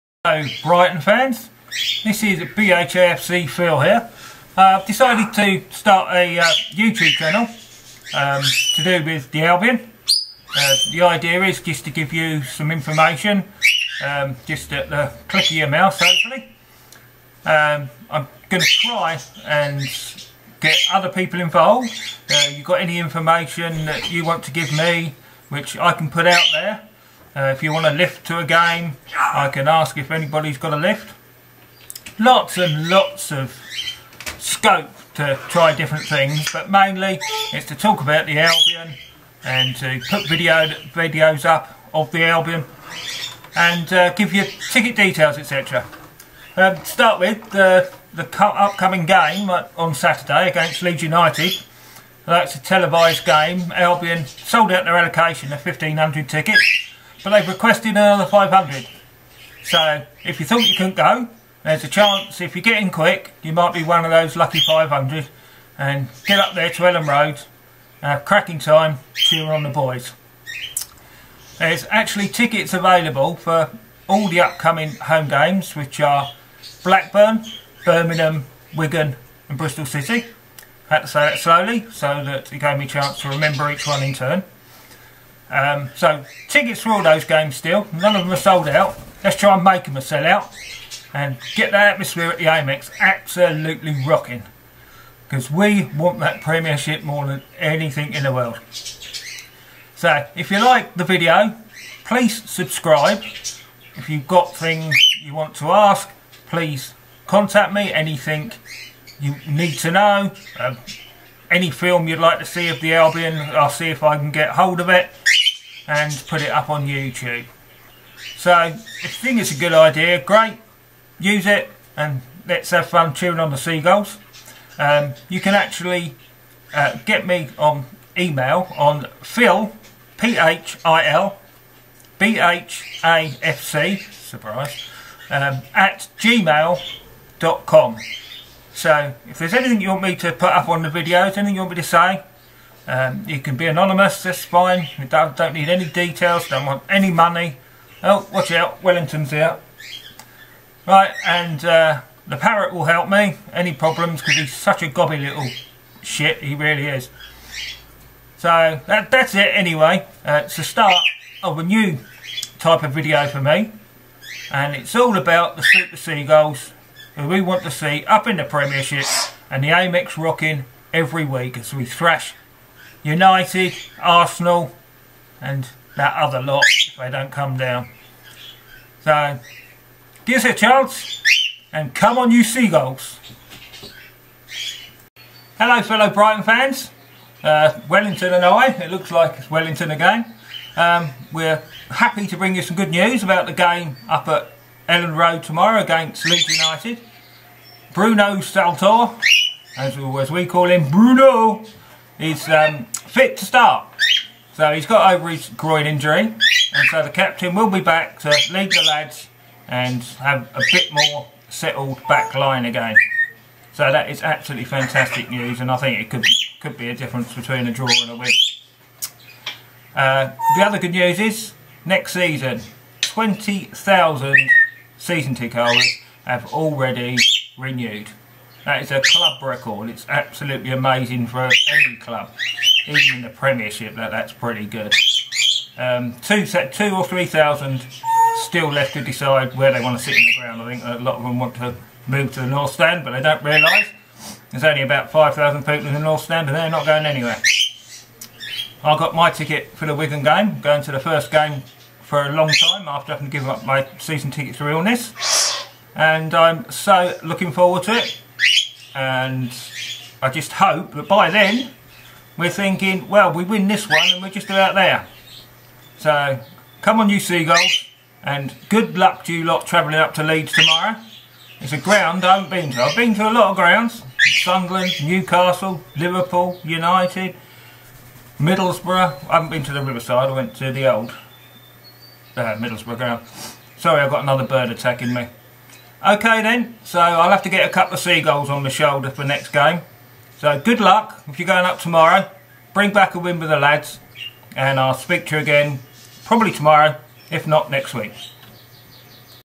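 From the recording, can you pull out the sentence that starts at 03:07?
Uh, Wellington and I, it looks like it's Wellington again.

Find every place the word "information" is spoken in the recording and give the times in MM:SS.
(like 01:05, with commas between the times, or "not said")
00:12, 00:22.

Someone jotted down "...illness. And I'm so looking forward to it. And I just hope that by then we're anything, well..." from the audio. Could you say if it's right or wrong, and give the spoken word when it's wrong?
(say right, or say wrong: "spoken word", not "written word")
wrong: "thinking", not "anything".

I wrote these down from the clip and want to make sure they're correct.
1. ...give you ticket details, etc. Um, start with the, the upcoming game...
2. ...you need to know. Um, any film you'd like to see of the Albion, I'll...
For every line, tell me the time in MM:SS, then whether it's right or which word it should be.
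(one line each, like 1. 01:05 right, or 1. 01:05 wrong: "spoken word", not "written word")
1. 00:44 right
2. 01:49 right.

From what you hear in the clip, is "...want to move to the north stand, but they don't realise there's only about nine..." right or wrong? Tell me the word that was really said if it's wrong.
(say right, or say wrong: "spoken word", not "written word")
wrong: "five", not "nine".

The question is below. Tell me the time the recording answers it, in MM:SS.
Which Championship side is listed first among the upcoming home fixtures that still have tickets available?
01:16.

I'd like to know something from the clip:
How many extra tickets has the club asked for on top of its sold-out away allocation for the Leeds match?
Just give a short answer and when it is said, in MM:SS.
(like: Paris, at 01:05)
500, at 00:57.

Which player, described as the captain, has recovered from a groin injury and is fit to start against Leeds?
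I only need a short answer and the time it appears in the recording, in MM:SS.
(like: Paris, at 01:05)
Bruno Saltor, at 03:17.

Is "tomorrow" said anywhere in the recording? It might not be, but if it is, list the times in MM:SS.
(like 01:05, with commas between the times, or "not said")
03:15, 04:30, 04:51, 04:56.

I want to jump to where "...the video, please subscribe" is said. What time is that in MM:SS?
01:40.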